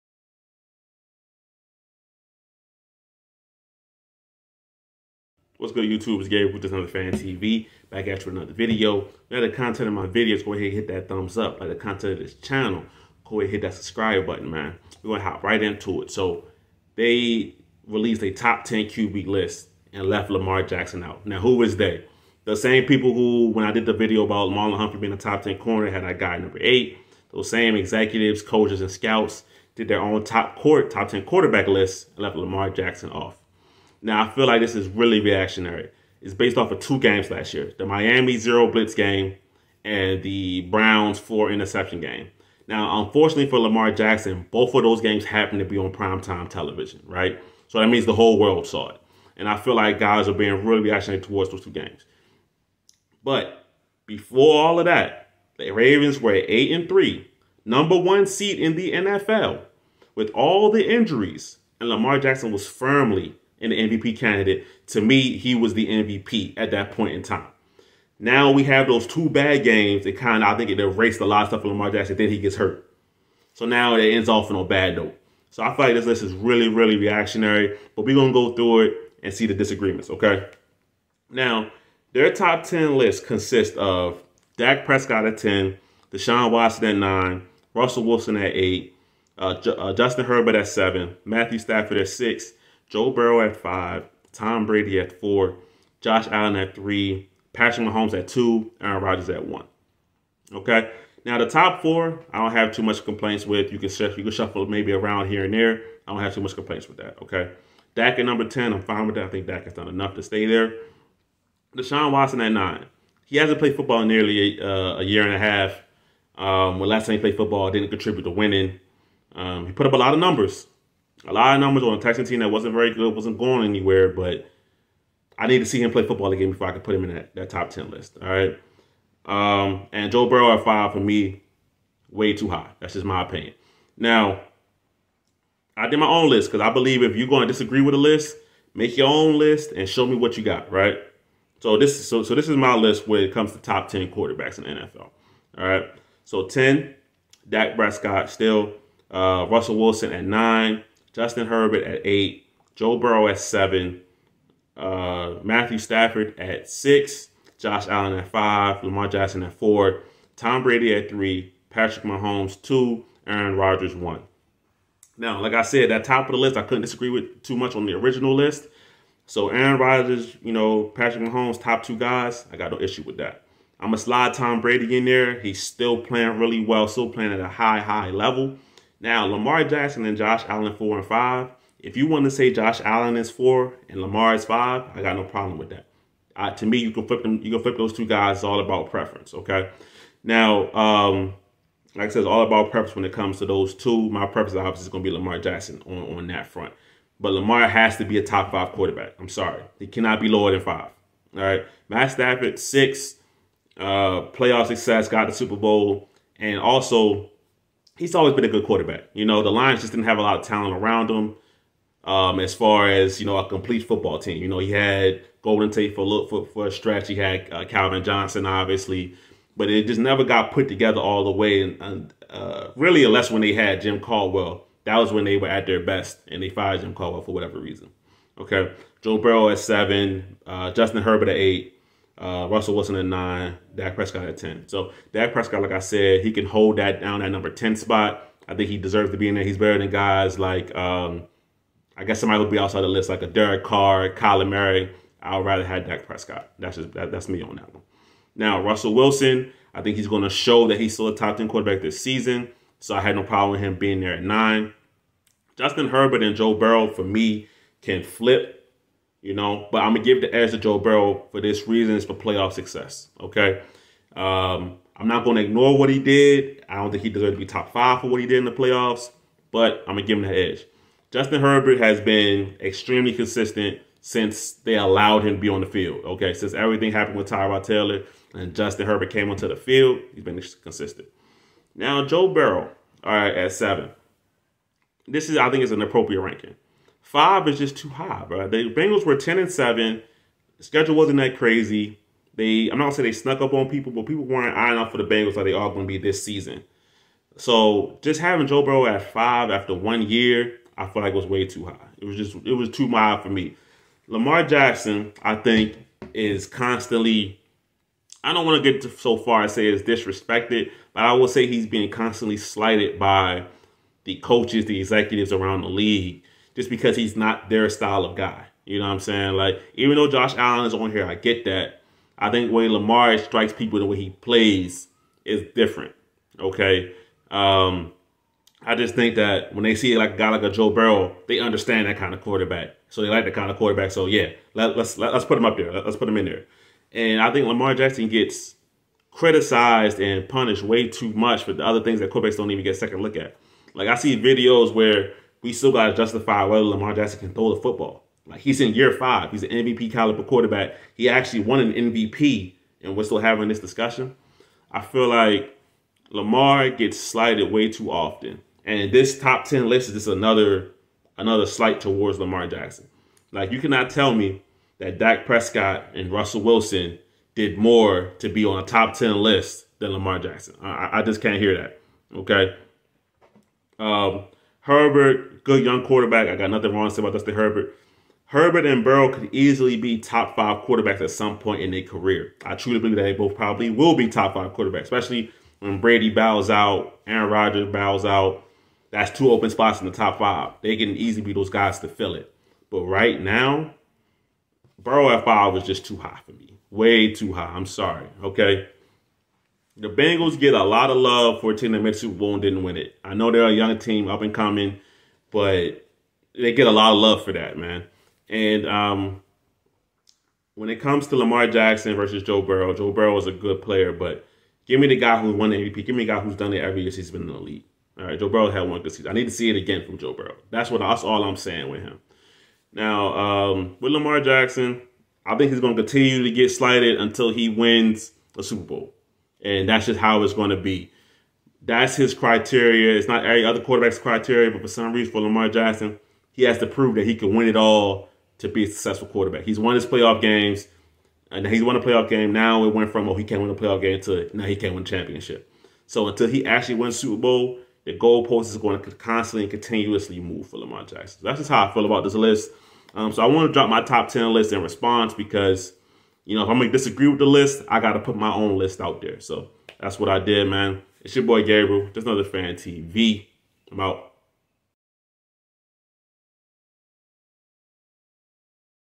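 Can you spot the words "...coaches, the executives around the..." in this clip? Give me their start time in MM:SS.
05:14.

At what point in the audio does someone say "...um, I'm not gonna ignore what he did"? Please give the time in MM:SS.
04:24.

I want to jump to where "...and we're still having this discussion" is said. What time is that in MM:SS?
05:52.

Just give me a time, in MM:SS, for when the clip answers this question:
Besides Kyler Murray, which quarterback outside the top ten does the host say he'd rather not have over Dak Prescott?
04:03.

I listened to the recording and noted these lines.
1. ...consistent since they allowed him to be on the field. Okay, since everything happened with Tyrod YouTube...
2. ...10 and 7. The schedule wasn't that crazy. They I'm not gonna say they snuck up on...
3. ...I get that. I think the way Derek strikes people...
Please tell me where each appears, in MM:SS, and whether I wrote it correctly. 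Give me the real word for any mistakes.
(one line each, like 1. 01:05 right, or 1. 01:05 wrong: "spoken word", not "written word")
1. 04:33 wrong: "Taylor", not "YouTube"
2. 04:49 right
3. 05:21 wrong: "Lamar", not "Derek".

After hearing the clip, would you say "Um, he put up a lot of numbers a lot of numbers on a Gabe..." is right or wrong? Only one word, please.
wrong.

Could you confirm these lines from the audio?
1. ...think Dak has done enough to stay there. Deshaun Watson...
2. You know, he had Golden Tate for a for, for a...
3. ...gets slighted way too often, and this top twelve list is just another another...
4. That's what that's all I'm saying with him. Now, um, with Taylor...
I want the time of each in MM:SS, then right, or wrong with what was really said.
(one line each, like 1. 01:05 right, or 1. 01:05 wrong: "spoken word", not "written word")
1. 01:49 right
2. 03:34 right
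3. 05:56 wrong: "ten", not "twelve"
4. 07:00 wrong: "Lamar", not "Taylor".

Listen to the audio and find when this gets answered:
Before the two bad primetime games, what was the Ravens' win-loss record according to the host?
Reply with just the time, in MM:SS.
00:56.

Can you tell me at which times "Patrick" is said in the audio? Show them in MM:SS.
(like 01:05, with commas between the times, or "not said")
01:37, 02:41, 02:50.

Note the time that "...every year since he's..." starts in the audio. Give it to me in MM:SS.
06:56.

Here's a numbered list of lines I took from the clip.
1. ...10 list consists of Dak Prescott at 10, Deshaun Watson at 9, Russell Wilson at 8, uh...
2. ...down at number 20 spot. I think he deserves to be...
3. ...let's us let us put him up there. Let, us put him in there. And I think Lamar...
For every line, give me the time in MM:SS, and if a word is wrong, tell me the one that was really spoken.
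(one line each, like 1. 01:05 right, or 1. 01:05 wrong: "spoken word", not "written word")
1. 01:22 right
2. 03:57 wrong: "10", not "20"
3. 05:34 right.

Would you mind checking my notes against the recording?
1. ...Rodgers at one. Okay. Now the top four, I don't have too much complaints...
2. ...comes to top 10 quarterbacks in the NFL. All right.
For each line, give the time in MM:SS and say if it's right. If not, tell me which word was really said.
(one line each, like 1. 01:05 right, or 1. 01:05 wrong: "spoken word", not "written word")
1. 01:39 right
2. 02:23 right.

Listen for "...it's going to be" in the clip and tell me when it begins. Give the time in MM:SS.
07:10.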